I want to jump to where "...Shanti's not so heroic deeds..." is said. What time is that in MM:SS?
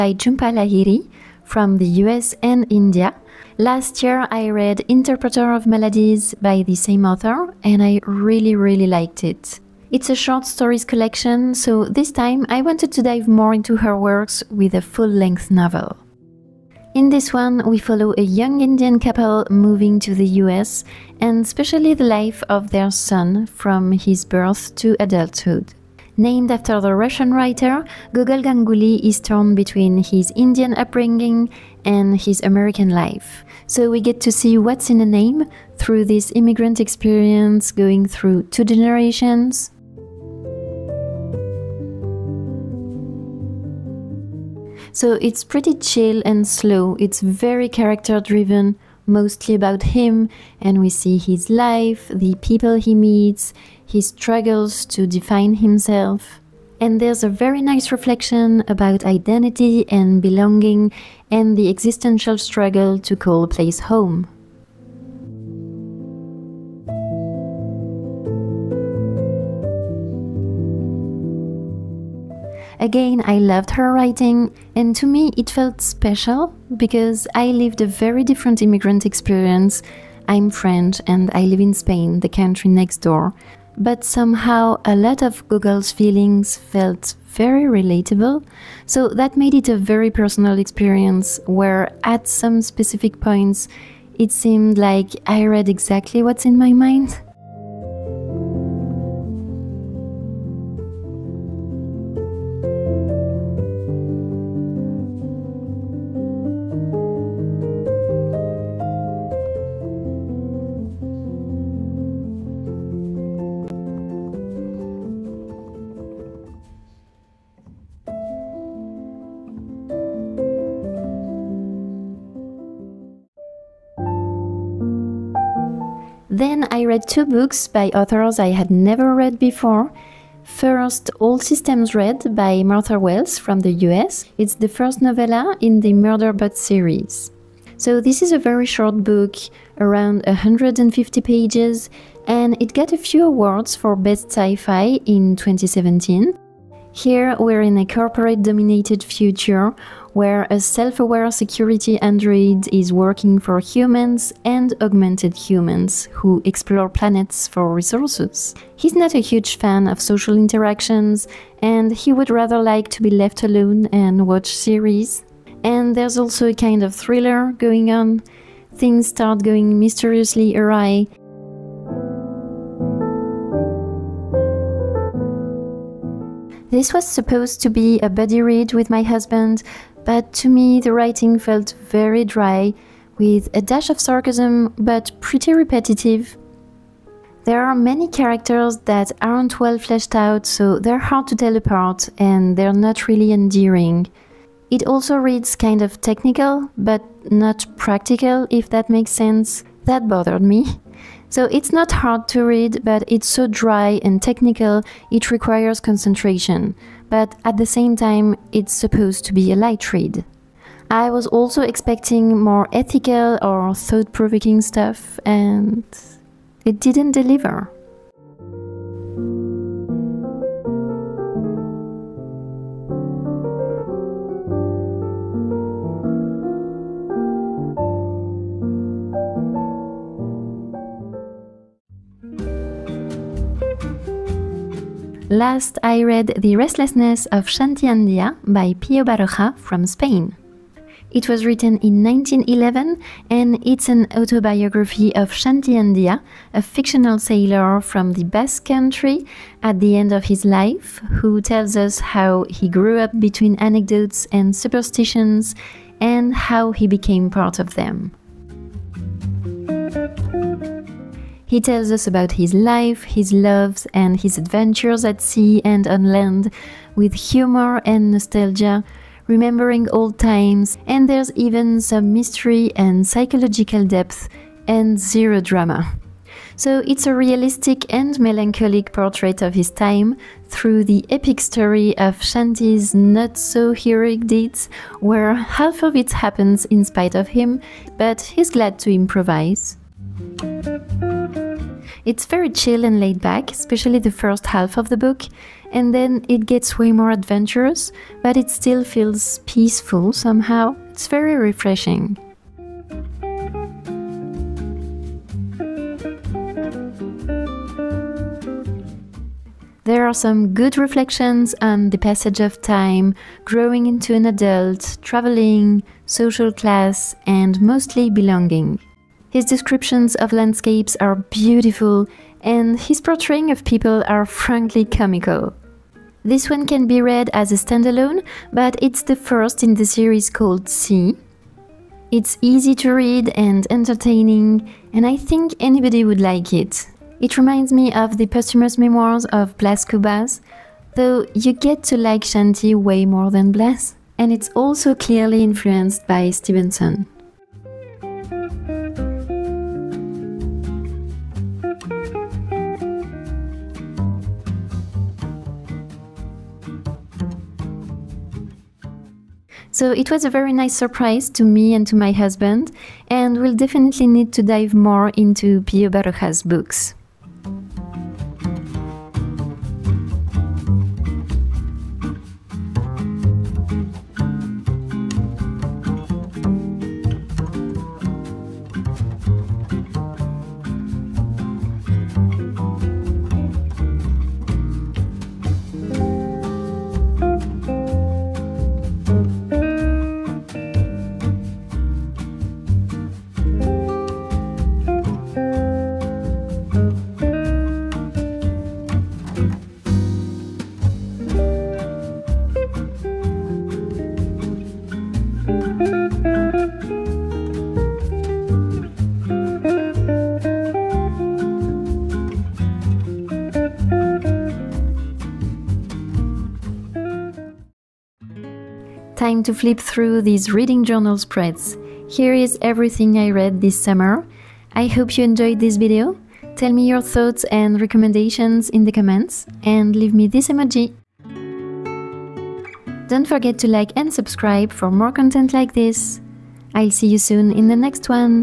04:42.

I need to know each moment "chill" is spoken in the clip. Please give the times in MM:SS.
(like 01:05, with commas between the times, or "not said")
00:45, 04:52.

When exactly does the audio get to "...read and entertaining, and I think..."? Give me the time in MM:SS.
05:32.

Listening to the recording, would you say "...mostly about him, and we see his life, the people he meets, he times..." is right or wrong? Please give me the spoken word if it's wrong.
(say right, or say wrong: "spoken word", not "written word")
wrong: "struggles", not "times".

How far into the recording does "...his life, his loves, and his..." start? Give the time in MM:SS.
04:22.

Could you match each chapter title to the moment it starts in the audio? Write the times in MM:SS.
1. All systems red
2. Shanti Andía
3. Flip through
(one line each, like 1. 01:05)
1. 02:03
2. 03:52
3. 06:57.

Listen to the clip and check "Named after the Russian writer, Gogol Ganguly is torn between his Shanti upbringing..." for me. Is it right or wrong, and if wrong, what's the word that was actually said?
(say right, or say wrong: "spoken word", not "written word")
wrong: "Indian", not "Shanti".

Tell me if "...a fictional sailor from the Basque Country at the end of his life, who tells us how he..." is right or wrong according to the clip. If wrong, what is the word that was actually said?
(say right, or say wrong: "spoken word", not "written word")
right.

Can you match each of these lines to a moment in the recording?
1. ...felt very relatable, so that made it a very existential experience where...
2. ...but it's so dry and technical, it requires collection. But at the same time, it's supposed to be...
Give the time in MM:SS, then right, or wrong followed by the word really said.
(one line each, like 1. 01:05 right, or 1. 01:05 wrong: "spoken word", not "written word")
1. 01:26 wrong: "personal", not "existential"
2. 03:22 wrong: "concentration", not "collection".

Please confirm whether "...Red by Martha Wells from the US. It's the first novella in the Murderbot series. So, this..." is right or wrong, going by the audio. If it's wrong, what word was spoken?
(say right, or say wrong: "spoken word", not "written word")
right.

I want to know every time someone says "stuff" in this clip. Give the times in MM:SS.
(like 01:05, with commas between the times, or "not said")
03:34.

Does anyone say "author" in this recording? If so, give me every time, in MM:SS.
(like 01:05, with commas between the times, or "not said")
00:07, 02:07.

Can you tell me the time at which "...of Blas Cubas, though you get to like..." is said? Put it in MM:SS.
05:39.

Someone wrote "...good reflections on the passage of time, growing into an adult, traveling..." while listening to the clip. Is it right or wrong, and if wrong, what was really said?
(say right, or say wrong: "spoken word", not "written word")
right.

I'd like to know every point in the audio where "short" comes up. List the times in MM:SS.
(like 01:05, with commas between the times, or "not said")
00:10, 02:18.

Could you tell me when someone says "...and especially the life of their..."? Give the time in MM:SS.
00:21.